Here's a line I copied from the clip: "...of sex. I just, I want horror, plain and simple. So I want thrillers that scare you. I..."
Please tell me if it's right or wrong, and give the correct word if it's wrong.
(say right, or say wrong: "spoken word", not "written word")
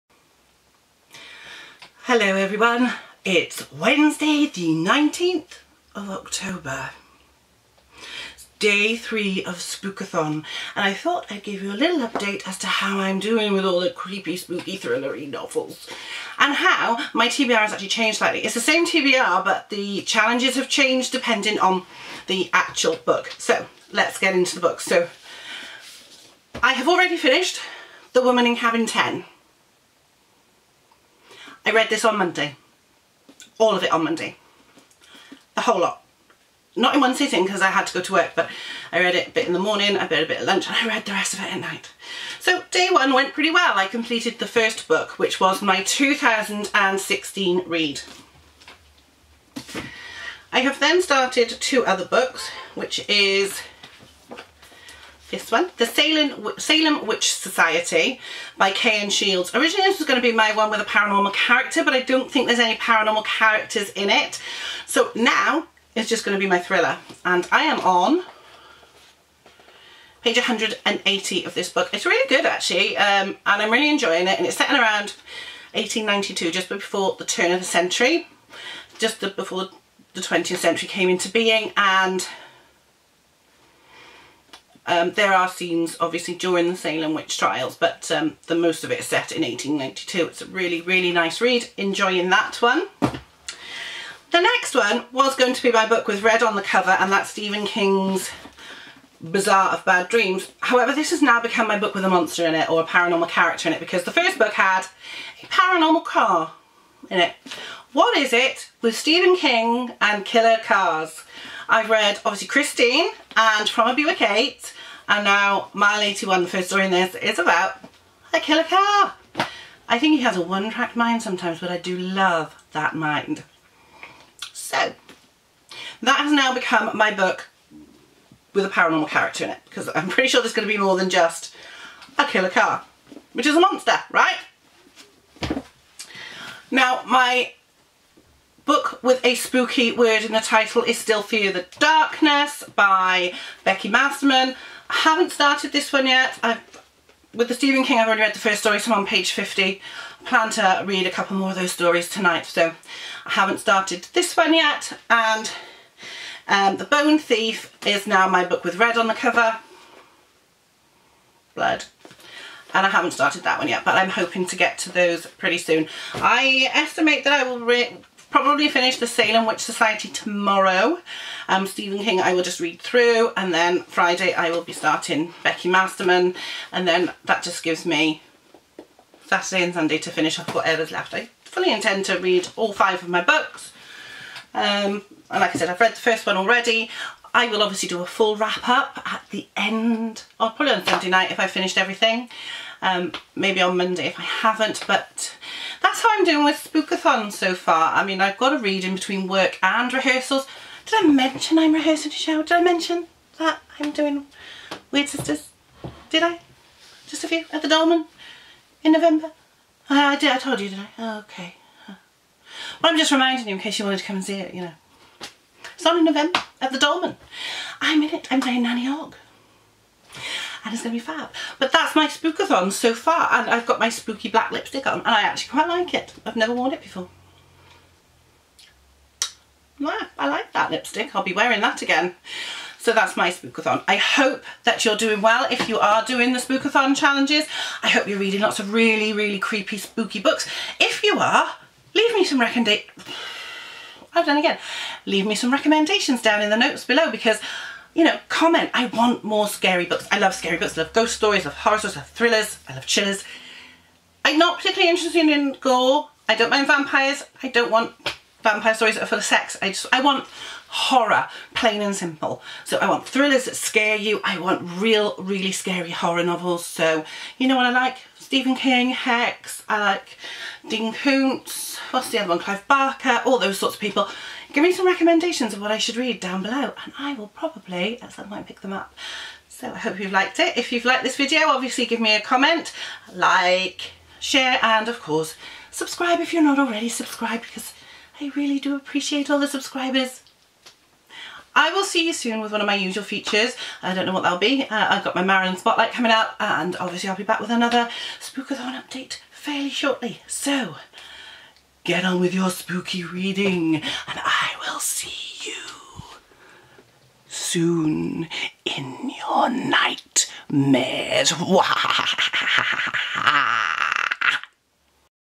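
right.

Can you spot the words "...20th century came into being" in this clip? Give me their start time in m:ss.
1:20.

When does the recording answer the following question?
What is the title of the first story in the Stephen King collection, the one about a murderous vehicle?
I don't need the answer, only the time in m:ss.
1:55.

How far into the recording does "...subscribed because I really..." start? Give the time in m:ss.
4:46.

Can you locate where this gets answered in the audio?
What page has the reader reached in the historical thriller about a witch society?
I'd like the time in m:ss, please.
1:10.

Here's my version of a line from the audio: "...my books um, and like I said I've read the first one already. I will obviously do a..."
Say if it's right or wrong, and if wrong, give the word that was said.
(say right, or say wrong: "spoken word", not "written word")
right.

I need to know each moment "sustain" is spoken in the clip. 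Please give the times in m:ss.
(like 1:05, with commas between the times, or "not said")
not said.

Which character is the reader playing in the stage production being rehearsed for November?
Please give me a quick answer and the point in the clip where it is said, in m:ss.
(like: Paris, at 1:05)
Nanny Ogg, at 3:38.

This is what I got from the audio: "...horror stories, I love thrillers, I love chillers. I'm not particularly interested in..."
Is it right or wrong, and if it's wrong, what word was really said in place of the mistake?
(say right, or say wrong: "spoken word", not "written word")
right.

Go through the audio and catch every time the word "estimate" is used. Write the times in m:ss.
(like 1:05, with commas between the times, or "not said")
2:46.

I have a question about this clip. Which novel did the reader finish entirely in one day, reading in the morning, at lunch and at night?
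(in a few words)
The Woman in Cabin 10.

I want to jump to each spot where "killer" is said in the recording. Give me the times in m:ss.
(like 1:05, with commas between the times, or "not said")
1:50, 1:58, 2:12.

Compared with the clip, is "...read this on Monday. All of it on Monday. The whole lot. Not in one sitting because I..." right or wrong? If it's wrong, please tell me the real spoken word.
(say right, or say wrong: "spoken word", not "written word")
right.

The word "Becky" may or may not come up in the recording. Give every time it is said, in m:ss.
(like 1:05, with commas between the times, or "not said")
2:23, 2:55.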